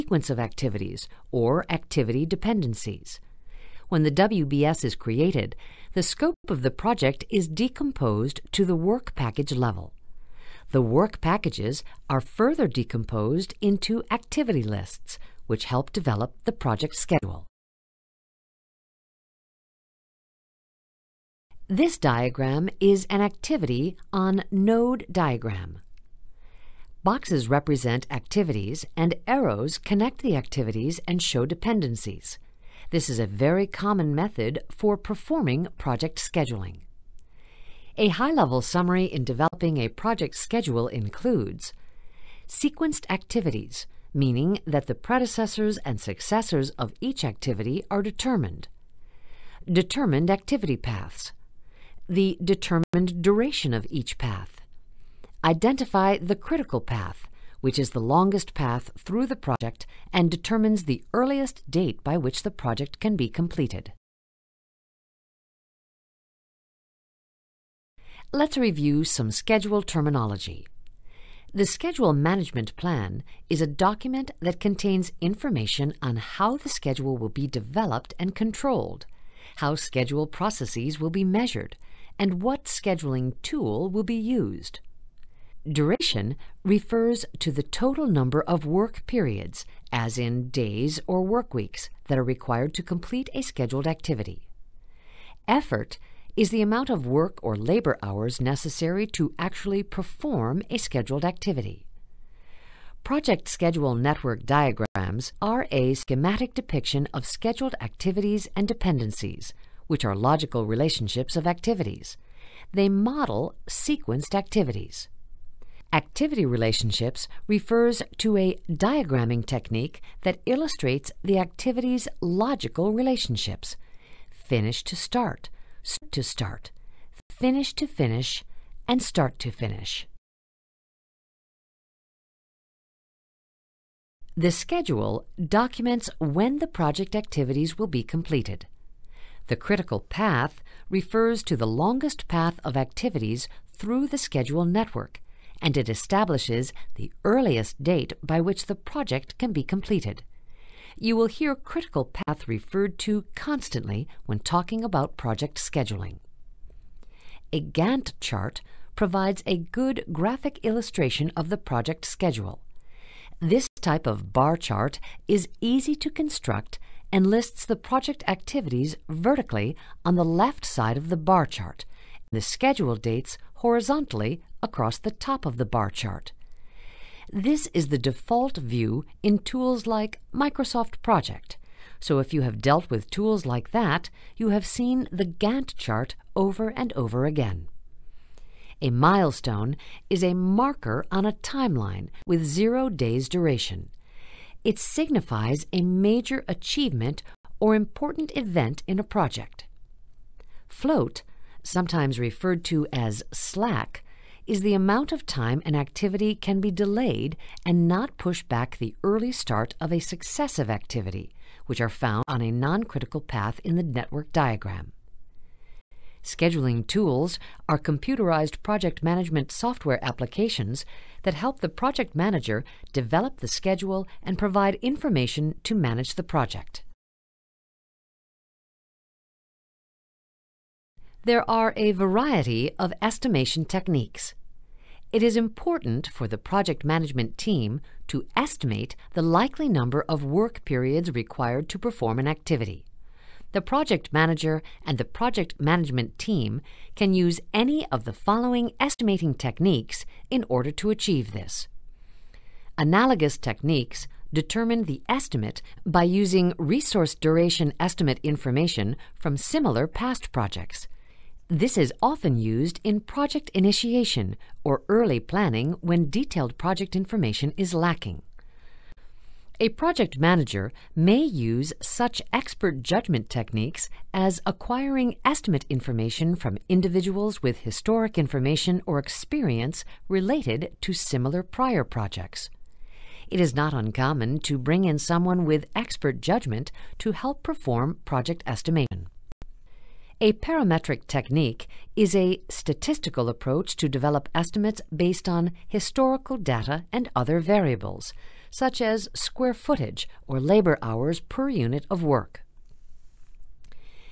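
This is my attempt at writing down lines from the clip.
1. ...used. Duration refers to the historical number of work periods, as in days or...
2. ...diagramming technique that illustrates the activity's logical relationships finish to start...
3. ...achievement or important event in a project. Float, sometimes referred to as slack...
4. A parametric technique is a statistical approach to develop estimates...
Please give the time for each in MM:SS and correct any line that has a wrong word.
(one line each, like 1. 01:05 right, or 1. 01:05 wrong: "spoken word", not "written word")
1. 01:24 wrong: "total", not "historical"
2. 01:58 right
3. 03:16 right
4. 04:50 right.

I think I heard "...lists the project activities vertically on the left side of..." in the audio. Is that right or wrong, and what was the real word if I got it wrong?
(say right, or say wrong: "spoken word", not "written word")
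right.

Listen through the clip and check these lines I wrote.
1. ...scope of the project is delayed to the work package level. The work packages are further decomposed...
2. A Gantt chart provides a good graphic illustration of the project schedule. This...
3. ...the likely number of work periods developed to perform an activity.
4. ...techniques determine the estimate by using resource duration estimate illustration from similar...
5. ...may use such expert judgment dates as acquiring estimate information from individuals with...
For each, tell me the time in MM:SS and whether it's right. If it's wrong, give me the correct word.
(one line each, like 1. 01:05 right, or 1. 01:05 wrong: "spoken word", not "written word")
1. 00:06 wrong: "decomposed", not "delayed"
2. 02:37 right
3. 03:59 wrong: "required", not "developed"
4. 04:13 wrong: "information", not "illustration"
5. 04:30 wrong: "techniques", not "dates".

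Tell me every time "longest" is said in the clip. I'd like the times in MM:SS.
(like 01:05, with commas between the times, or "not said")
00:58, 02:21.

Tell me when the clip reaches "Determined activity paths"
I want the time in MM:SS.
00:49.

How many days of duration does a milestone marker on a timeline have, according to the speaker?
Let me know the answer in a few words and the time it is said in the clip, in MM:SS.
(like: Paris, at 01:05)
0, at 03:12.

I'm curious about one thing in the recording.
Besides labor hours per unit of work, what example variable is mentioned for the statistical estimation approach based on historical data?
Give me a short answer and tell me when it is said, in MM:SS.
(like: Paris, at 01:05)
Square footage, at 04:59.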